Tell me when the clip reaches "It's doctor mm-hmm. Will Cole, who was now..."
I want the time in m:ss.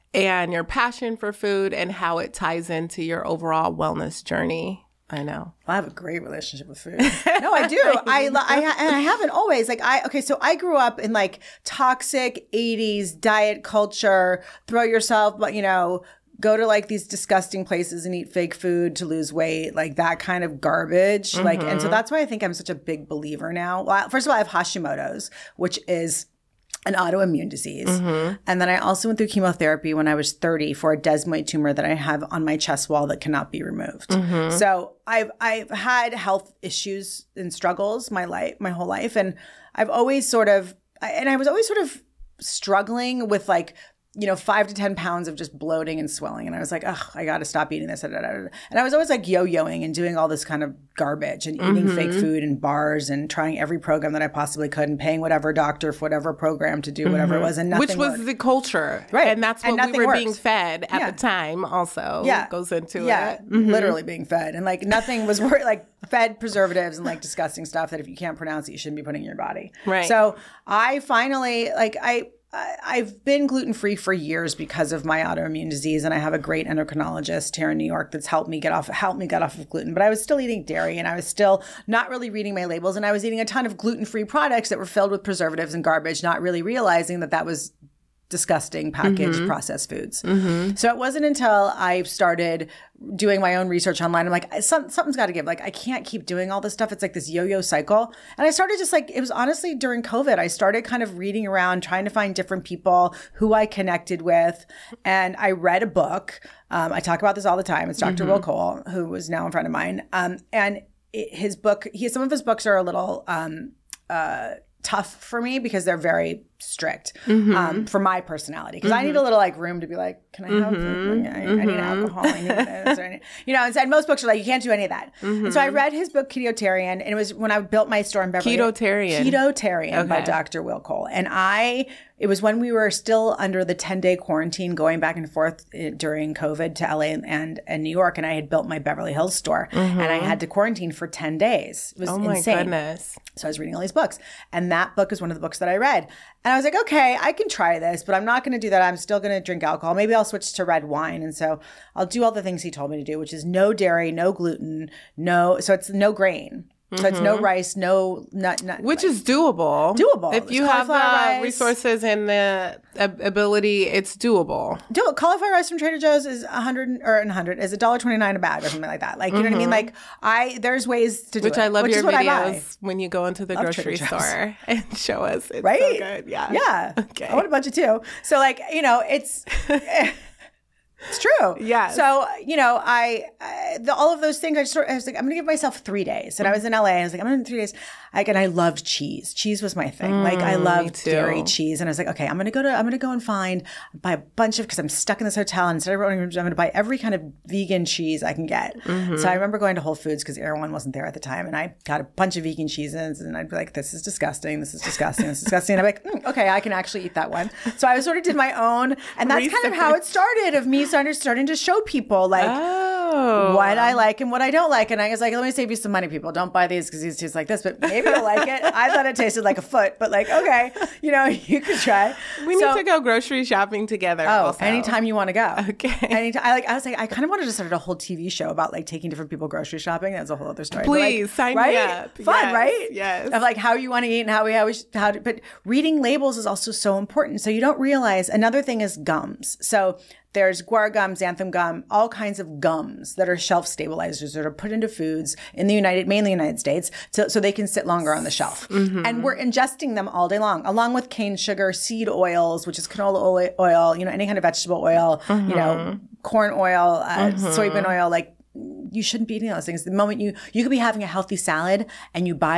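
1:47.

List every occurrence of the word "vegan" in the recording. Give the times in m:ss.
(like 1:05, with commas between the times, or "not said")
3:17, 3:22.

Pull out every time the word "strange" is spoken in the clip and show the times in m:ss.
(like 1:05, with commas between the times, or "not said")
not said.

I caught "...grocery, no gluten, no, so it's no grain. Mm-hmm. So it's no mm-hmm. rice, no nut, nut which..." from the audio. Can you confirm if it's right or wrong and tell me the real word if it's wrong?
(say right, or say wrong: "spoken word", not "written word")
wrong: "dairy", not "grocery".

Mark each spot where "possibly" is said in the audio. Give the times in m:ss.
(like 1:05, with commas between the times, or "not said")
0:54.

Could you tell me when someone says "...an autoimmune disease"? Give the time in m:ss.
0:26.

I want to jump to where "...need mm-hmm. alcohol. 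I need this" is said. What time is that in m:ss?
2:01.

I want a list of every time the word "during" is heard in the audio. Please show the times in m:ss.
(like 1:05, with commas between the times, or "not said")
1:39, 2:15.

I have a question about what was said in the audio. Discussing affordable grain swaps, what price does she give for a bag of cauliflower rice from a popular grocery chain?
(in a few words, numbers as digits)
$1.29.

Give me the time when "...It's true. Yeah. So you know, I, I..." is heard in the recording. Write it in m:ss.
3:01.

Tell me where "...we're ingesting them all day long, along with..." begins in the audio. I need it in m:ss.
4:09.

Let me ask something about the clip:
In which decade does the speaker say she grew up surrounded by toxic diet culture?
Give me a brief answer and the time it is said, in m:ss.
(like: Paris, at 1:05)
1980s, at 0:12.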